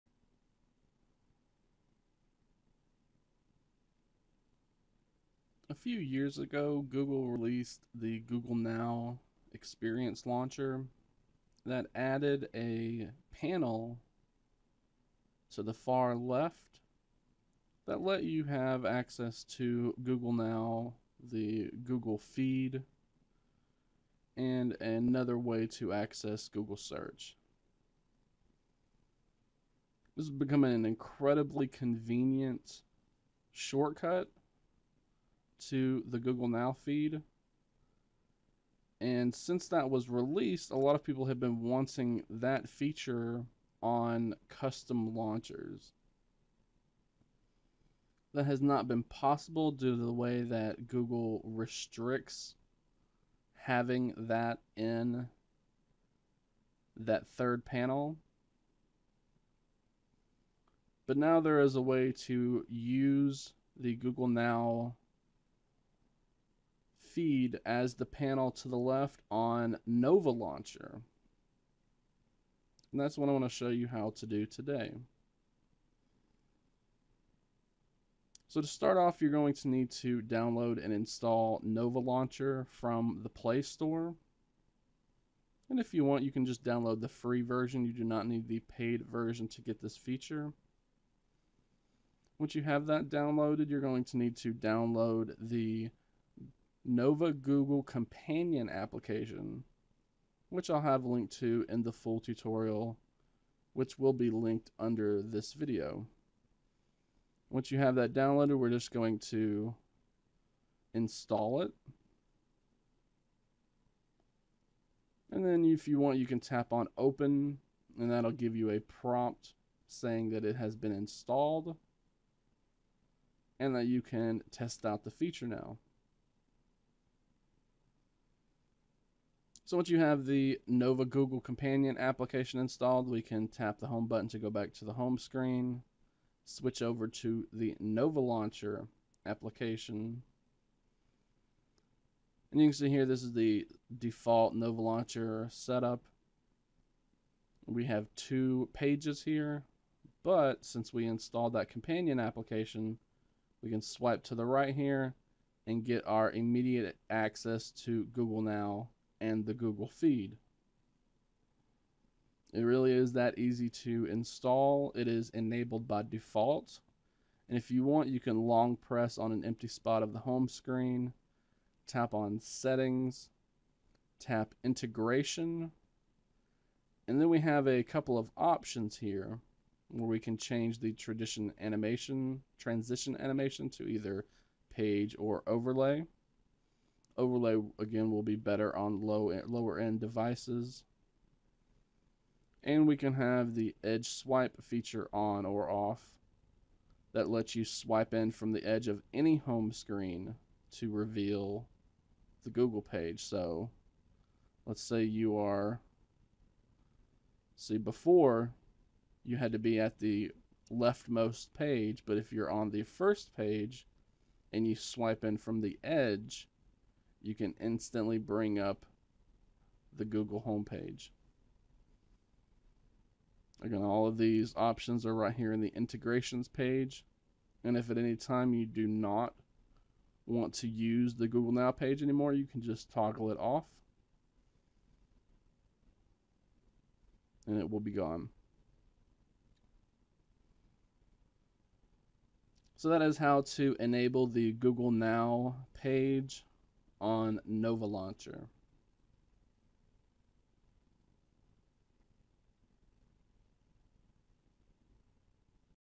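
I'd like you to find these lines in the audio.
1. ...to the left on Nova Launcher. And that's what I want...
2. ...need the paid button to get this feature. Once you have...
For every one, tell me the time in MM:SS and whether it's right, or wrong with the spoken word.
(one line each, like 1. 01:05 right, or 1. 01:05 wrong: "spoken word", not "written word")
1. 01:08 right
2. 01:28 wrong: "version", not "button".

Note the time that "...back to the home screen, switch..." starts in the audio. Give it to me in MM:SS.
02:14.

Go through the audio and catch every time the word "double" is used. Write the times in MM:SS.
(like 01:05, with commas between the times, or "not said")
not said.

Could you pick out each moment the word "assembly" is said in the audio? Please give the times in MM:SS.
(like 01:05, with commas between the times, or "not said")
not said.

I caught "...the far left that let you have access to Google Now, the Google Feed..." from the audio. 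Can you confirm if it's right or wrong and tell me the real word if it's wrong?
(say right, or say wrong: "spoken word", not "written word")
right.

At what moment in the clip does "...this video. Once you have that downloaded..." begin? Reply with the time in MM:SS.
01:45.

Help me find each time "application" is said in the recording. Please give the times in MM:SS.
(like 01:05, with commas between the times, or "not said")
01:38, 02:11, 02:19, 02:32.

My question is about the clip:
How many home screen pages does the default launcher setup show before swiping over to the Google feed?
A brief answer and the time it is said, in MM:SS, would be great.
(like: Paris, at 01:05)
2, at 02:28.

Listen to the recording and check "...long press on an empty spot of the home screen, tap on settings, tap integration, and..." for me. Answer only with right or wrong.
right.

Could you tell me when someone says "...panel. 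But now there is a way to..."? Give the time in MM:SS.
00:57.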